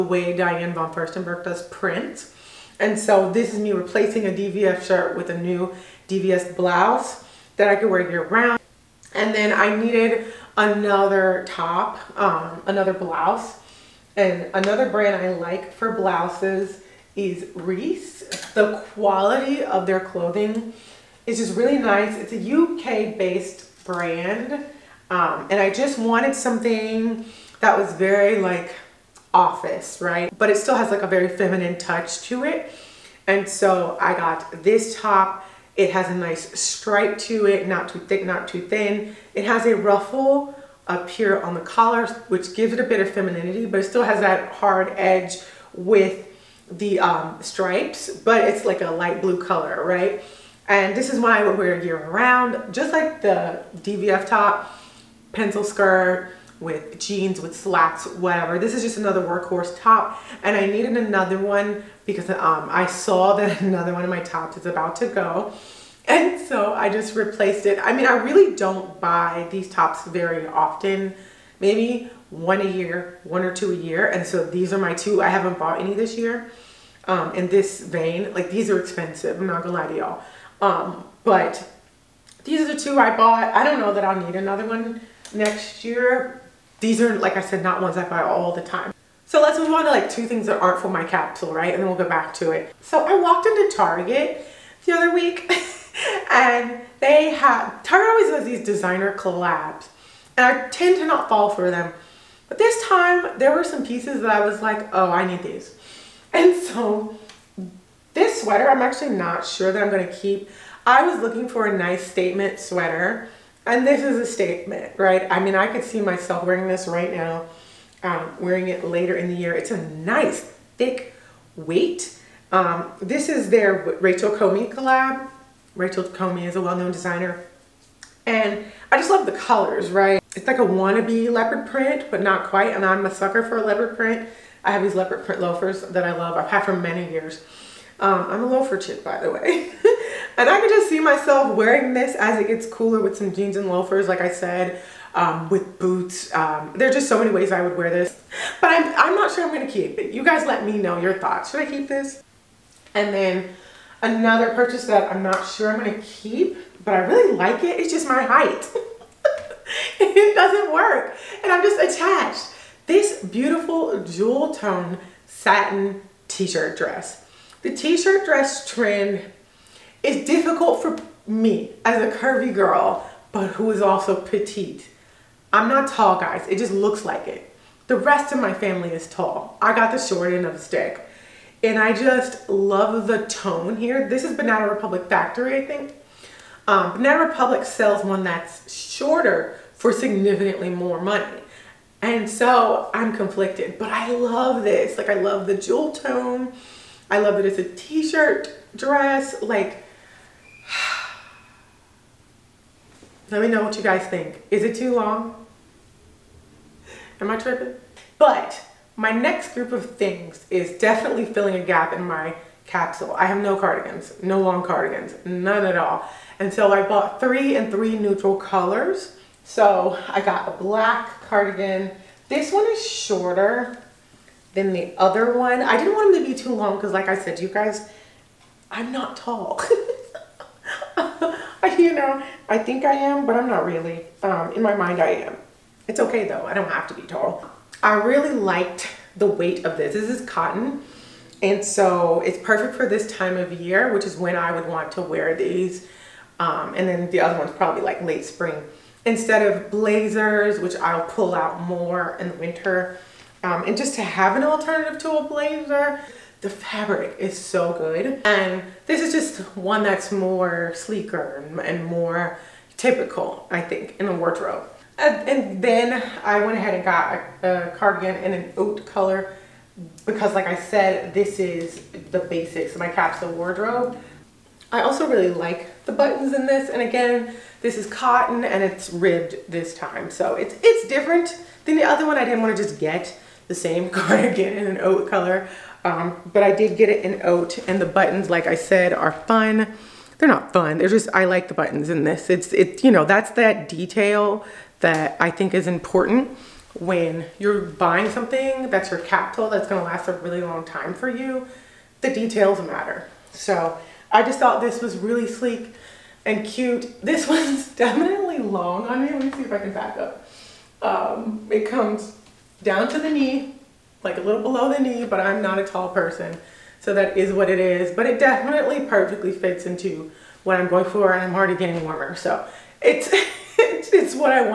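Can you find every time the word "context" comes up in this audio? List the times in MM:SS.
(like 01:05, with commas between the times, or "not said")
not said.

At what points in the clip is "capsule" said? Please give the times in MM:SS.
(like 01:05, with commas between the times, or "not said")
01:31, 03:32, 04:32.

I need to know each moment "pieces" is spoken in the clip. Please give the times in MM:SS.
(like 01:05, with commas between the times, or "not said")
01:43.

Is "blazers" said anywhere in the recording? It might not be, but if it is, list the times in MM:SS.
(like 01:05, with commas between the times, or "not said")
04:09, 04:15.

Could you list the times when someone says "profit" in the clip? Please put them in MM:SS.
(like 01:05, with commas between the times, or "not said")
not said.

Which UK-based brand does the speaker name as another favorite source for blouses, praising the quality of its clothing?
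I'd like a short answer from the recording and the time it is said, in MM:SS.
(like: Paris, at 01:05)
Reiss, at 00:17.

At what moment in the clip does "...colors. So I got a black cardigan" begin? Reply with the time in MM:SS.
03:38.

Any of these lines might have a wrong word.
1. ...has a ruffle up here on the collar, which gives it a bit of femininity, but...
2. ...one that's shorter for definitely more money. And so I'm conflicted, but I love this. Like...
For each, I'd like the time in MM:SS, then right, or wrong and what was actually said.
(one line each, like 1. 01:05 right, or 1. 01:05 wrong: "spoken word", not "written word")
1. 00:39 right
2. 03:08 wrong: "significantly", not "definitely".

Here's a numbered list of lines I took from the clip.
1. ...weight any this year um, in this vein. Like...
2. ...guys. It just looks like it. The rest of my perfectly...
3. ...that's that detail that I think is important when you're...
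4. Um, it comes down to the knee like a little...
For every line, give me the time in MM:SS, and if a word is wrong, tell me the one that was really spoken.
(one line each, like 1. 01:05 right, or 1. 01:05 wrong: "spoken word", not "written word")
1. 01:15 wrong: "bought", not "weight"
2. 02:56 wrong: "family", not "perfectly"
3. 04:53 right
4. 05:10 right.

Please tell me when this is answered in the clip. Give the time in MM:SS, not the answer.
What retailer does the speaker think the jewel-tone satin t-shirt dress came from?
03:04.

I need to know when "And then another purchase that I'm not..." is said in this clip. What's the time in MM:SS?
02:32.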